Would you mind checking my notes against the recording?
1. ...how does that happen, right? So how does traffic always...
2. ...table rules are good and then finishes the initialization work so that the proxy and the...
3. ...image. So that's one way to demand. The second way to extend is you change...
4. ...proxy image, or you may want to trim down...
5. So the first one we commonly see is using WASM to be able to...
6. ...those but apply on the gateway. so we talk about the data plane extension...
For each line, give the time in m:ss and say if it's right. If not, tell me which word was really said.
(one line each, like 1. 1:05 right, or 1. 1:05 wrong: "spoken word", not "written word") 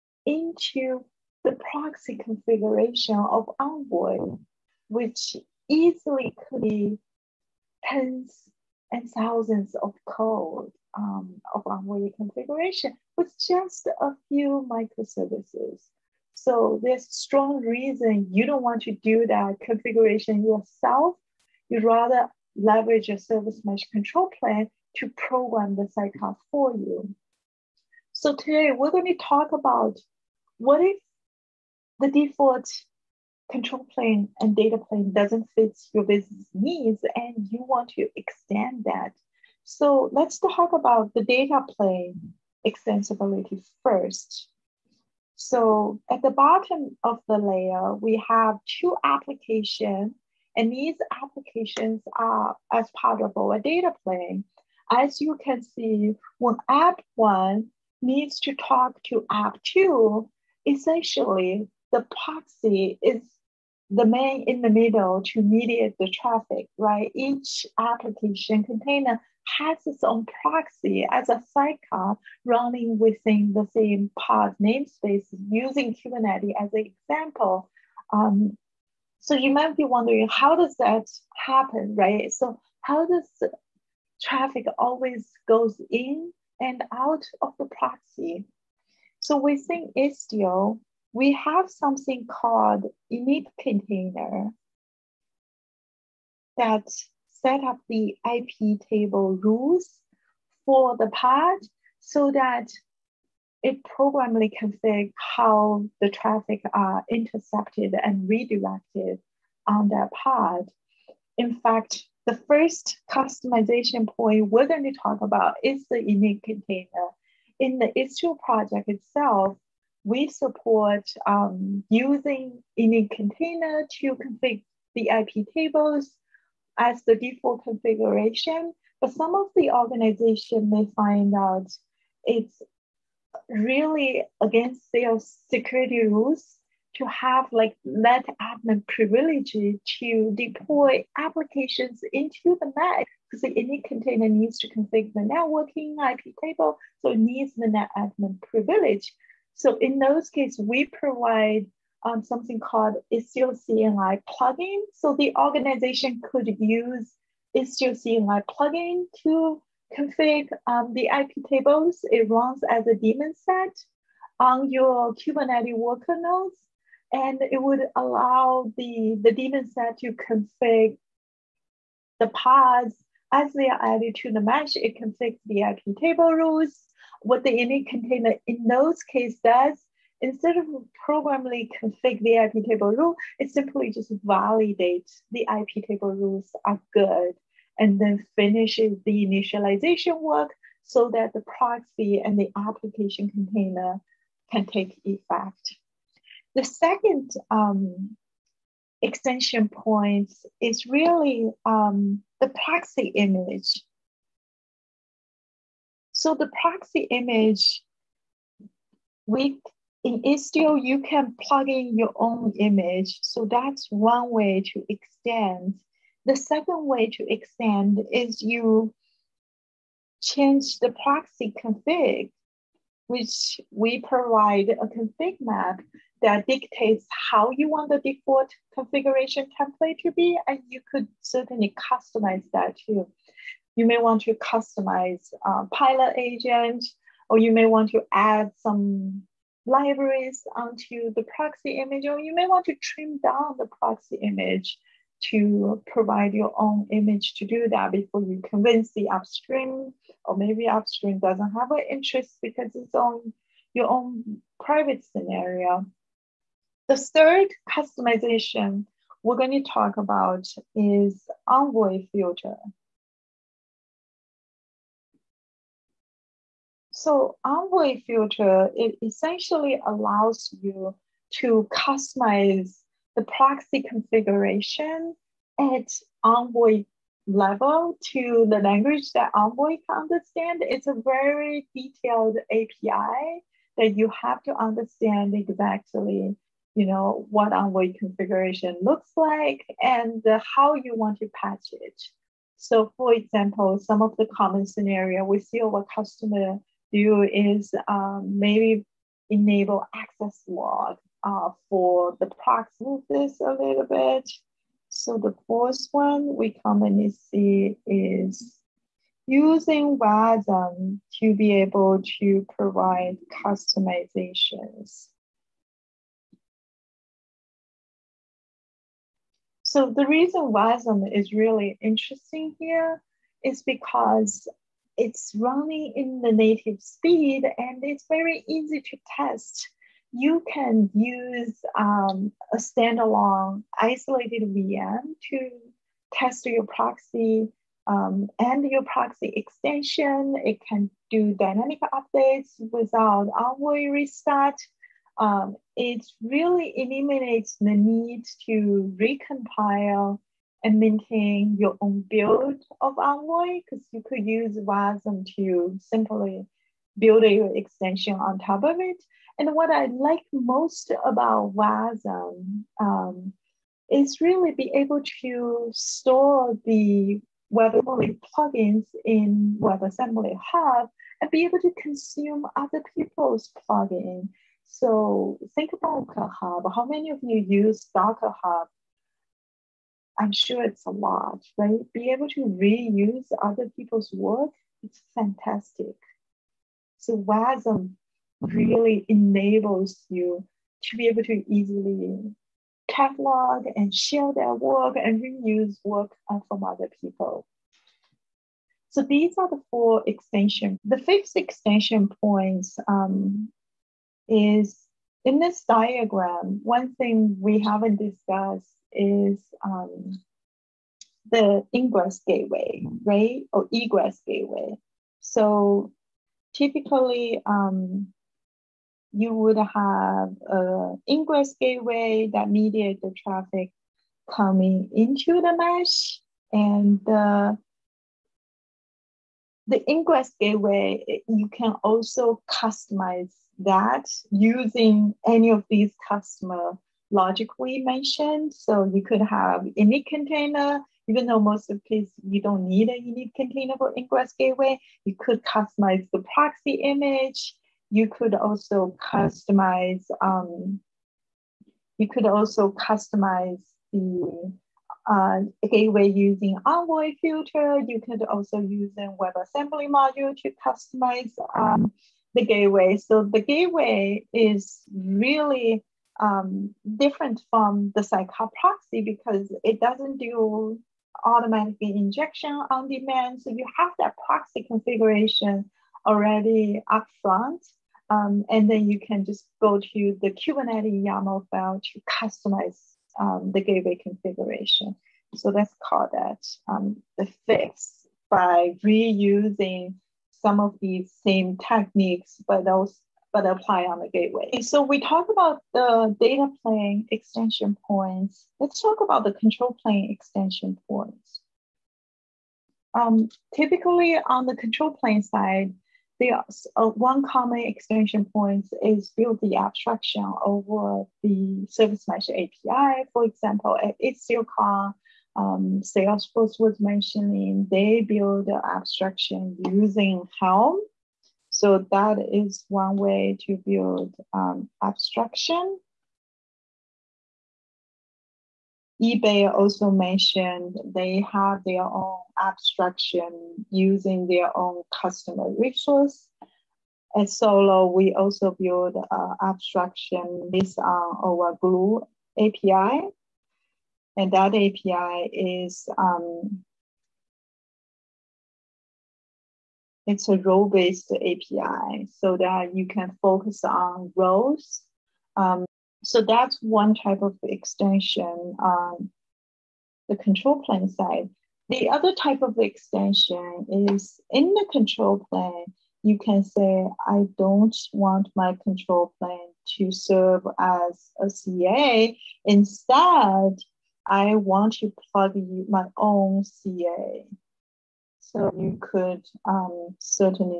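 1. 1:20 right
2. 3:05 right
3. 3:32 wrong: "extend", not "demand"
4. 4:01 right
5. 5:04 right
6. 8:12 right.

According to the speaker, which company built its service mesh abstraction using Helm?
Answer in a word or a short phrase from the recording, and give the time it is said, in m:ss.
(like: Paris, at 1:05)
Salesforce, at 8:35.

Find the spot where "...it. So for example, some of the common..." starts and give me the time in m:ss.
4:51.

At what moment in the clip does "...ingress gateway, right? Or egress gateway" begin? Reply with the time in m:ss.
6:51.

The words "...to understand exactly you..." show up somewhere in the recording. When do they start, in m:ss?
4:44.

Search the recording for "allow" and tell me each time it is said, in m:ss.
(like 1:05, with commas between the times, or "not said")
2:47, 4:29.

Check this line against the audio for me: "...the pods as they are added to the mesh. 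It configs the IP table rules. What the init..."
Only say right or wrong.
right.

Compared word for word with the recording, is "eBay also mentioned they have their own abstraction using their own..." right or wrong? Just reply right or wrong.
right.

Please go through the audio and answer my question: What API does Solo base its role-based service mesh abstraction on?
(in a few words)
Gloo API.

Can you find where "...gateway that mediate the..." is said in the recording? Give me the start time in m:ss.
7:01.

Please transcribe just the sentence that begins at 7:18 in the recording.
So you could have init container, even though most of the case you don't need a init container for ingress gateway.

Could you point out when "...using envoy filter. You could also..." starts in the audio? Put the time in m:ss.
7:36.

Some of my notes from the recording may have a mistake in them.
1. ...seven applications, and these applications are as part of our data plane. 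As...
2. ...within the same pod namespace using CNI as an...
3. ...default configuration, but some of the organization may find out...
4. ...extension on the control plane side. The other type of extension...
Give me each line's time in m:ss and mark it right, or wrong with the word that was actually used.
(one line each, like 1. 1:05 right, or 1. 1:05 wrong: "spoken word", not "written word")
1. 0:48 wrong: "two", not "seven"
2. 1:12 wrong: "Kubernetes", not "CNI"
3. 2:07 right
4. 9:17 right.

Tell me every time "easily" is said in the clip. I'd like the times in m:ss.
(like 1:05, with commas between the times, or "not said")
0:05, 6:31.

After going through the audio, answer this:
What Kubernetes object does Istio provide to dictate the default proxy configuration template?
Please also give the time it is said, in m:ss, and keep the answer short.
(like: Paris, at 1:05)
config map, at 3:44.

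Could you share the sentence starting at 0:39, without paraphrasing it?
So let's talk about the data plane extensibility first.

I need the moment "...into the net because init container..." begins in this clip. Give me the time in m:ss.
2:22.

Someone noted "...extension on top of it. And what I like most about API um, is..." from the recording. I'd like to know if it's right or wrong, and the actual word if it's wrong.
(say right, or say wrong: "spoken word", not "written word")
wrong: "WASM", not "API".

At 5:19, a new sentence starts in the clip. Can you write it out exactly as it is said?
So the reason WASM is really interesting here is because it's running in the native speed and it's very easy to test.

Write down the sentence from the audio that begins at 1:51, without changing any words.
In fact, the first customization point we're going to talk about is the init container.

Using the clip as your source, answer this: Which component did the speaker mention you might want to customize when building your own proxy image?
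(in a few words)
pilot agent.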